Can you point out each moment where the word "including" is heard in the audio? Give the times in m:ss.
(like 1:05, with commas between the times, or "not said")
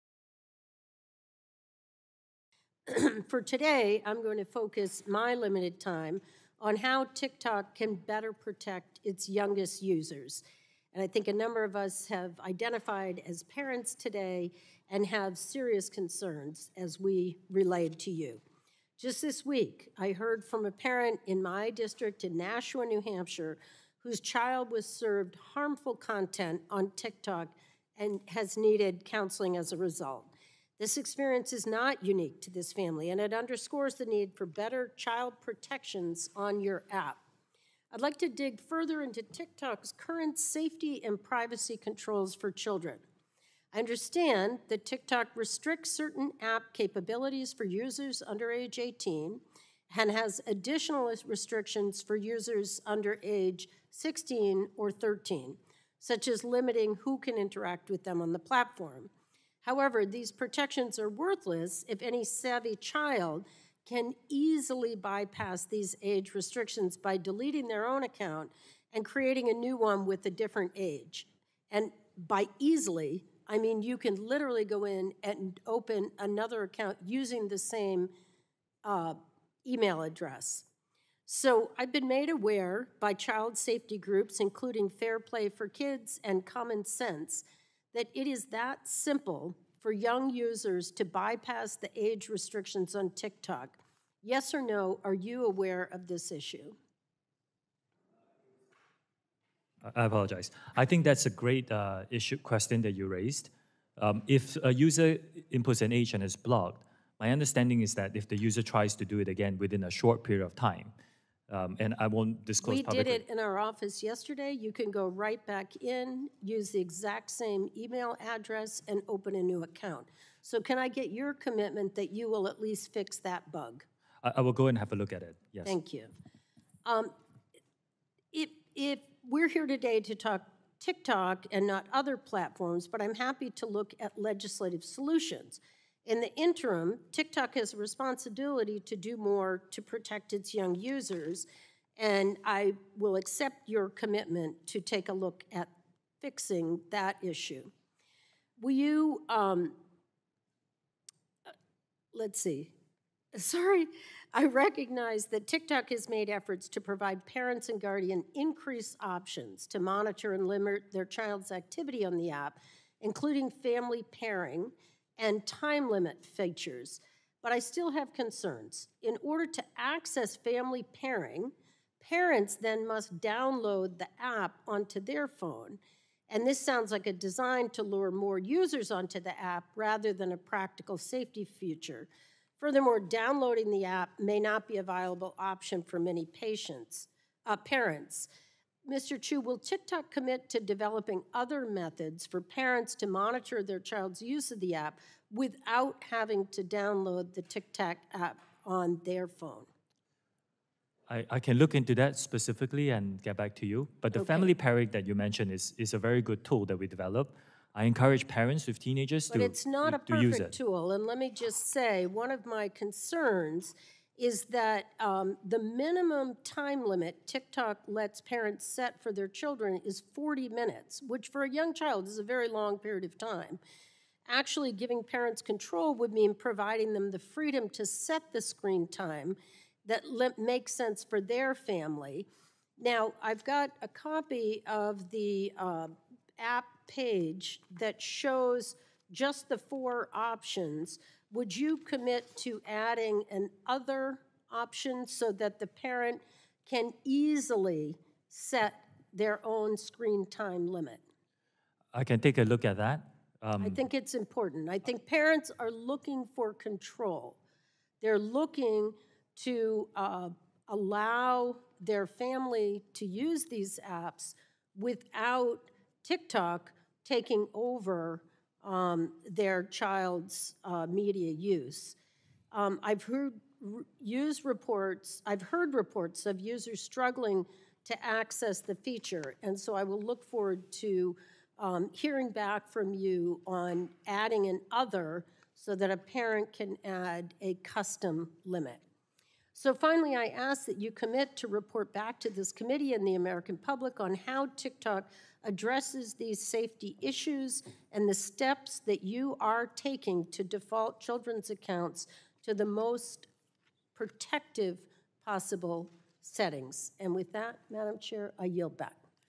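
1:24, 2:43.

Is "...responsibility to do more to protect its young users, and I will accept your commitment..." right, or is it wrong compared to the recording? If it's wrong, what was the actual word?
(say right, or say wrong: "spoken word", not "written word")
right.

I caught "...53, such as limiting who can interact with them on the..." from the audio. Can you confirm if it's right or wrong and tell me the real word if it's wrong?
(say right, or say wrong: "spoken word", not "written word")
wrong: "13", not "53".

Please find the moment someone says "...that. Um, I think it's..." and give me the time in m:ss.
4:12.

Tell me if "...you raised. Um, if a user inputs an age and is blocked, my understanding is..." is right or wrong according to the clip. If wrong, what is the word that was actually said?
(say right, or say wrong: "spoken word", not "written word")
right.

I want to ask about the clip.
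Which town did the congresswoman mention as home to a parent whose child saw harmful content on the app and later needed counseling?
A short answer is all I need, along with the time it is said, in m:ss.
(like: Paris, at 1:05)
Nashua, New Hampshire, at 0:22.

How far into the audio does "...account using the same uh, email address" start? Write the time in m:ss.
1:16.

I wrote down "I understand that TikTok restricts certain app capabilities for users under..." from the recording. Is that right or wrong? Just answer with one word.
right.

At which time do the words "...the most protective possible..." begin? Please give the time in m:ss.
5:02.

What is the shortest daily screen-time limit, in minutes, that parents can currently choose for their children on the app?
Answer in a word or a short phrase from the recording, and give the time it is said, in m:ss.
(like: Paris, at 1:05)
40 minutes, at 3:40.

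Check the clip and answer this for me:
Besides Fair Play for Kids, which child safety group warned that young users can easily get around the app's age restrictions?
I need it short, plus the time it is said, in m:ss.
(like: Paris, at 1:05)
Common Sense, at 1:26.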